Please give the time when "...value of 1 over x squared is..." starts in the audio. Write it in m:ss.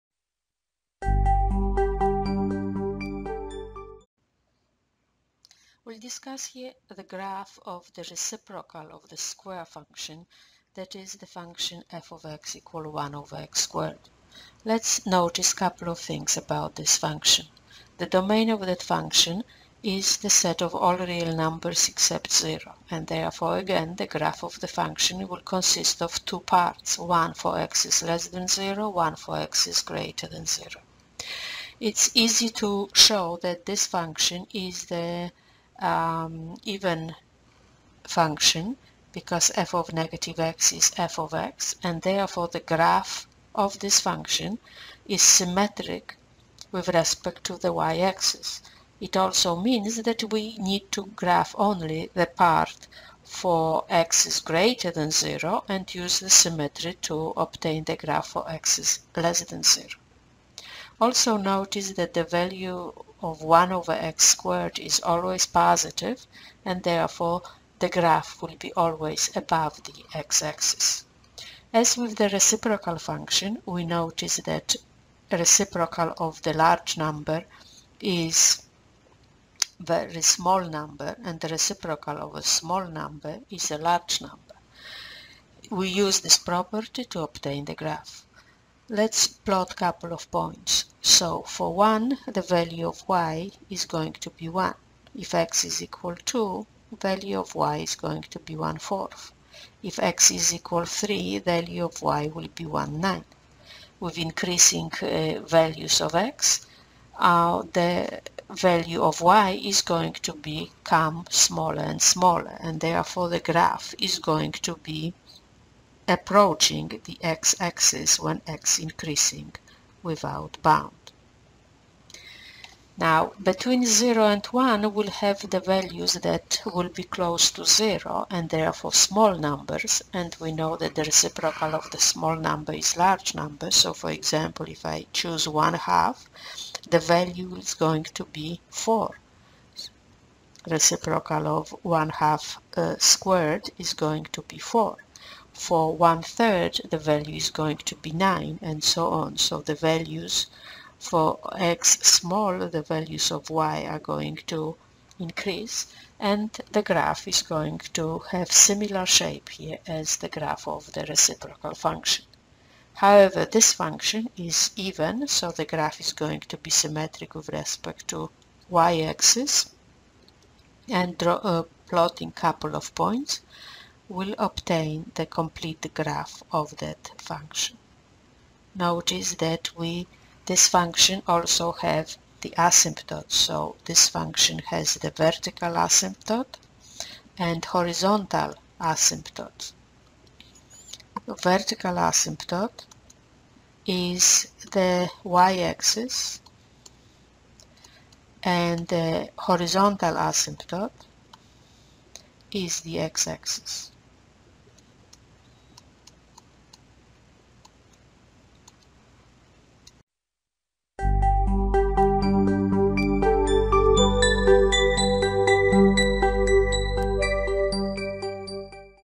1:02.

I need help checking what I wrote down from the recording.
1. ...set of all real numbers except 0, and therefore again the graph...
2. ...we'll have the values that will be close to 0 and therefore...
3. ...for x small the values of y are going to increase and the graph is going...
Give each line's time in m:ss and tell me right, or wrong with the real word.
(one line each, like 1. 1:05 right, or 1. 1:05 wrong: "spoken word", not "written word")
1. 0:20 right
2. 2:04 right
3. 2:30 right.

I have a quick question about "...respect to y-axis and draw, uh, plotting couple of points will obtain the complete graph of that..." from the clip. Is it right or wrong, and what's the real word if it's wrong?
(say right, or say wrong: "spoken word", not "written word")
right.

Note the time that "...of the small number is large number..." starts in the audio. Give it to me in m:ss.
2:11.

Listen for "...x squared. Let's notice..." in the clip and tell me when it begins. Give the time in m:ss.
0:13.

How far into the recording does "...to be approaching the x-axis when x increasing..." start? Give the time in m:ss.
1:54.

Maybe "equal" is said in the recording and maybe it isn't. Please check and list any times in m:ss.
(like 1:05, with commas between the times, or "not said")
0:12, 1:35, 1:40.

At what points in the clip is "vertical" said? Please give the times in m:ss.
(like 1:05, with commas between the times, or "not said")
3:05, 3:11.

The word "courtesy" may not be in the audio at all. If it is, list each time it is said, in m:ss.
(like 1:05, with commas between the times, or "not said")
not said.